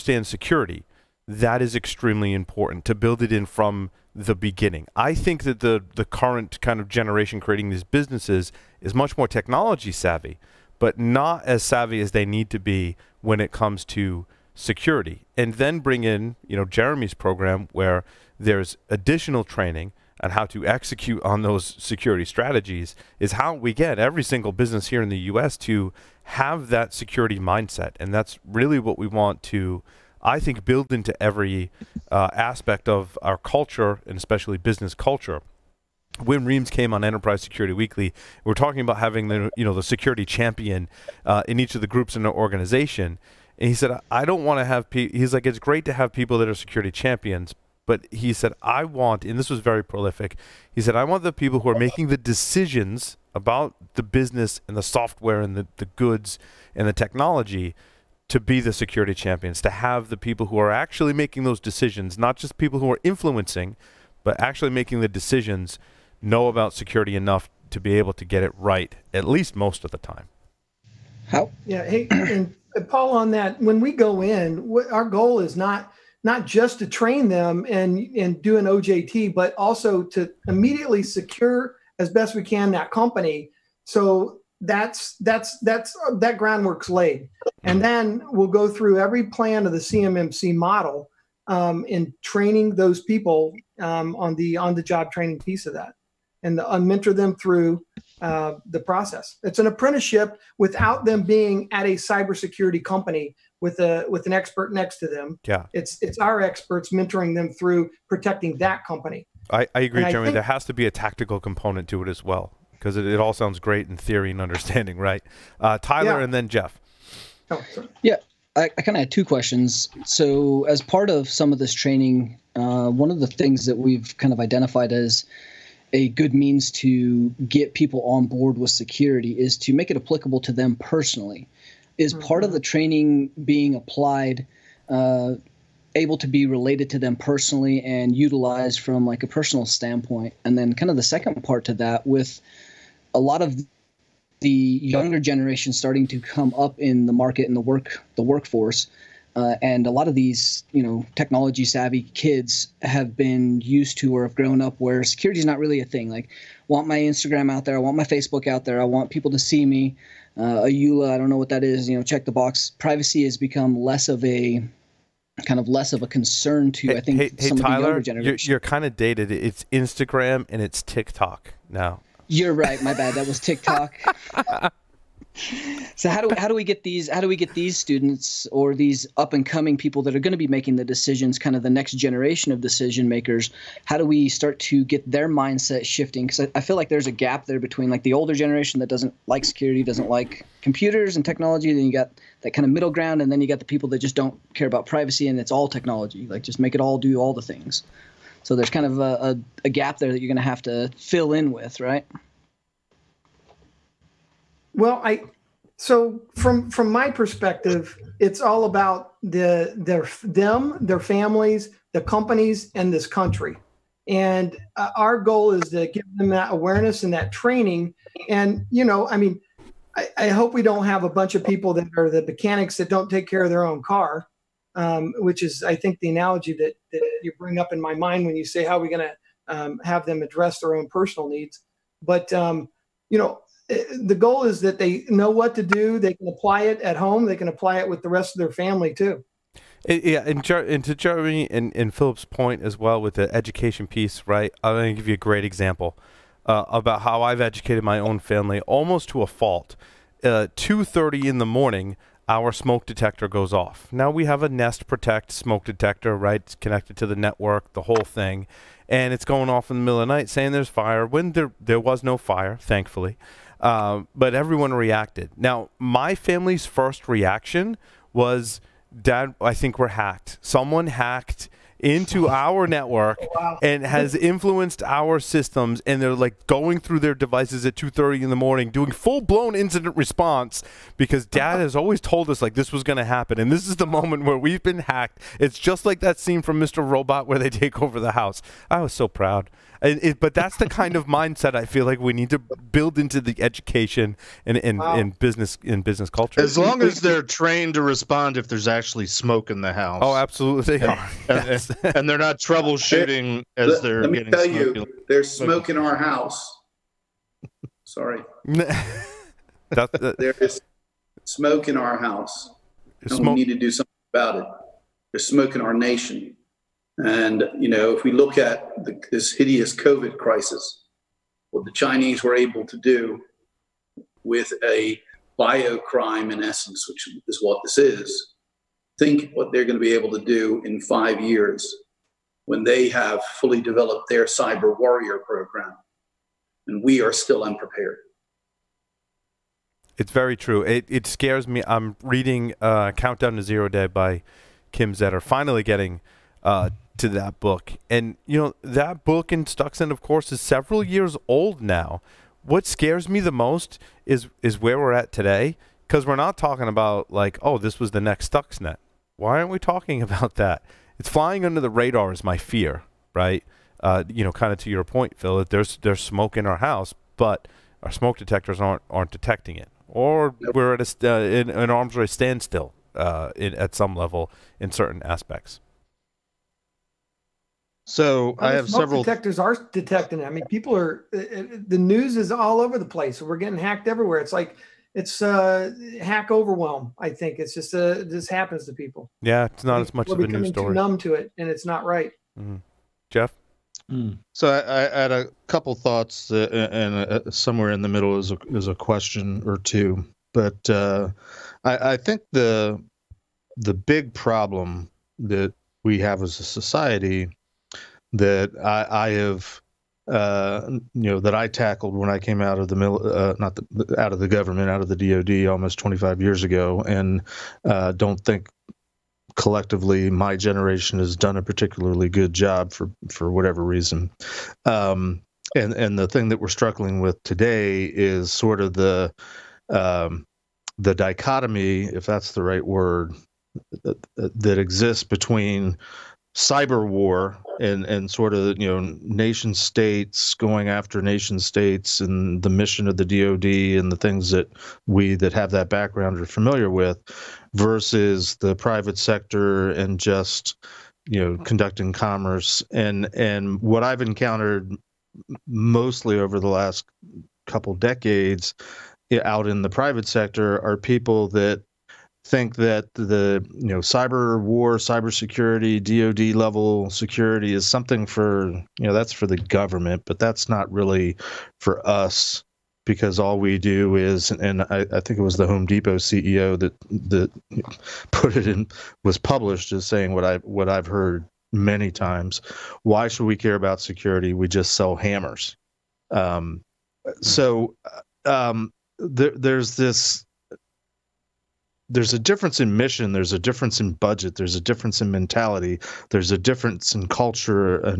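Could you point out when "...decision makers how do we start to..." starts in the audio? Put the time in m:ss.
3:02.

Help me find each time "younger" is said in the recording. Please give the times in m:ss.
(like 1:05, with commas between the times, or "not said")
2:24, 2:47.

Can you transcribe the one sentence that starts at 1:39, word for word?
It's an apprenticeship without them being at a cybersecurity company with a with an expert next to them.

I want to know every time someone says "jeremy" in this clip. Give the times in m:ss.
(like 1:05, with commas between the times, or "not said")
0:16, 1:50, 4:00.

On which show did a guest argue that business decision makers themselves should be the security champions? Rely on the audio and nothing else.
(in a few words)
Enterprise Security Weekly.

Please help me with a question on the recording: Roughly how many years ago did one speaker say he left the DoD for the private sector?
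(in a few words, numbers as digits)
25.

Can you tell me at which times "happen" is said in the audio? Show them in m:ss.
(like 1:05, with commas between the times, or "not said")
4:43, 6:28.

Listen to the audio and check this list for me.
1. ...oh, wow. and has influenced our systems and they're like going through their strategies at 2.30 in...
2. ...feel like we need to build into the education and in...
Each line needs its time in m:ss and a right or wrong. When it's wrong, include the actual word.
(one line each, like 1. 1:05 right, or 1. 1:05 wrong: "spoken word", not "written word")
1. 4:33 wrong: "devices", not "strategies"
2. 4:51 right.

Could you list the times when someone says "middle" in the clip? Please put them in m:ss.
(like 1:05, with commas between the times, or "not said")
3:12, 4:19, 6:37.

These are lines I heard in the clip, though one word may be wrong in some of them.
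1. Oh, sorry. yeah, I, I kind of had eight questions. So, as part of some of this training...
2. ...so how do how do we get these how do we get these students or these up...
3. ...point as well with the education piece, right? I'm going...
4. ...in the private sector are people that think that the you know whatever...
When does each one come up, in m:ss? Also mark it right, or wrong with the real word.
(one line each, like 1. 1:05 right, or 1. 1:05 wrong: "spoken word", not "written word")
1. 1:57 wrong: "two", not "eight"
2. 2:55 right
3. 4:02 right
4. 7:39 wrong: "cyber", not "whatever".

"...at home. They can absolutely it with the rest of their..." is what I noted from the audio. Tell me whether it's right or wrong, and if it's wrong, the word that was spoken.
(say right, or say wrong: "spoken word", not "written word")
wrong: "apply", not "absolutely".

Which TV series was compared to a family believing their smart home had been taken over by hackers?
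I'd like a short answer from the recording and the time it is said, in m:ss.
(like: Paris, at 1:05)
Mr. Robot, at 4:46.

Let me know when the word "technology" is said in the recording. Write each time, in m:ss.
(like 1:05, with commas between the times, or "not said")
0:09, 0:56, 2:31, 3:11, 3:15.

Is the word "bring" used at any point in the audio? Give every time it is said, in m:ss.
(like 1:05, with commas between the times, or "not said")
0:15, 3:47.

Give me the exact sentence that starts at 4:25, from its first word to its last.
Now, my family's first reaction was, Dad, I think we're hacked.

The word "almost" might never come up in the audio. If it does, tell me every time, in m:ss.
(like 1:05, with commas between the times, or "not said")
4:08, 6:55.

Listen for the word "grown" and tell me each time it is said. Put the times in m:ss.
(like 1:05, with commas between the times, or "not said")
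2:34.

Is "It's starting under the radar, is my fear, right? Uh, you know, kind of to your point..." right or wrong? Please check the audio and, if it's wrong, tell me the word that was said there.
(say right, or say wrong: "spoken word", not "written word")
wrong: "flying", not "starting".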